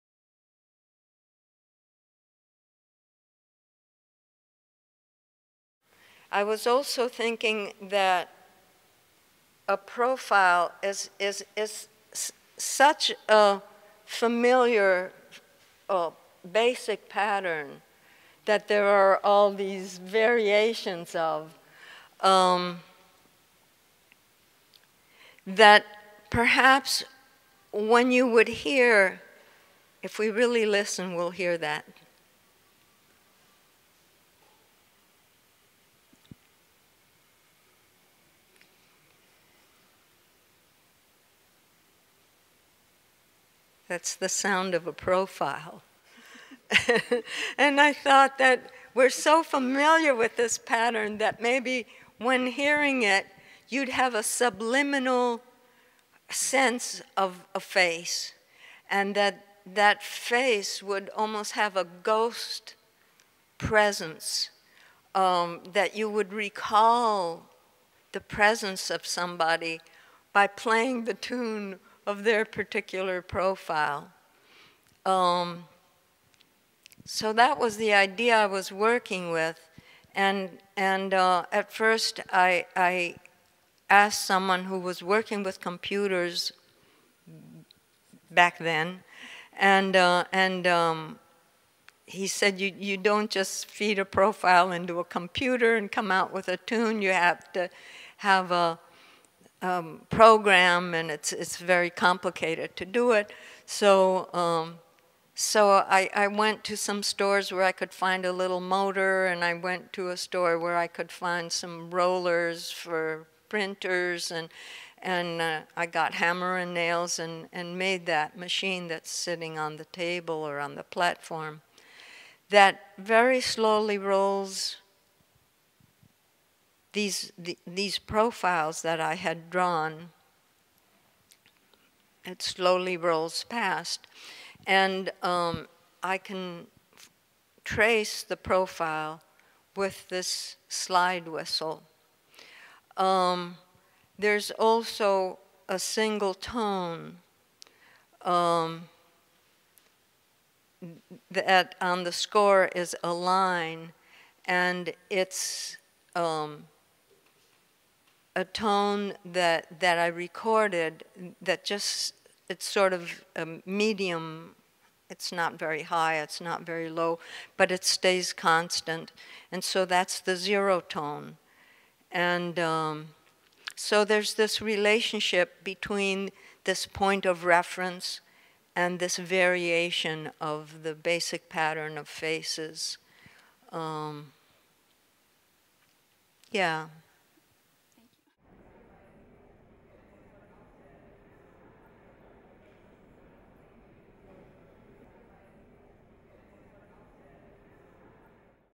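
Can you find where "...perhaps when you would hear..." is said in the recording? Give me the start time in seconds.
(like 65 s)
26 s.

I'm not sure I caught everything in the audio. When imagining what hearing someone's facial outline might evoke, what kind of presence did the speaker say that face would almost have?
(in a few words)
ghost presence.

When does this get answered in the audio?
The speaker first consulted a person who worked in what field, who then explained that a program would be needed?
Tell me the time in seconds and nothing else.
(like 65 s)
85 s.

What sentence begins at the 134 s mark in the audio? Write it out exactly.
And um, I can trace the profile with this slide whistle.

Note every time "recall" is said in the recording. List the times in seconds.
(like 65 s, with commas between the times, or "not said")
66 s.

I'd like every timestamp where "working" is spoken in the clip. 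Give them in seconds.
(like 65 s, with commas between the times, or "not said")
78 s, 85 s.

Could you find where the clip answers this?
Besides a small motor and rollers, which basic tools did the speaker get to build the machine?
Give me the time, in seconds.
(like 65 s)
116 s.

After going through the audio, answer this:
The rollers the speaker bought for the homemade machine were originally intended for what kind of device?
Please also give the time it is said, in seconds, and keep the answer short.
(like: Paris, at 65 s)
printers, at 113 s.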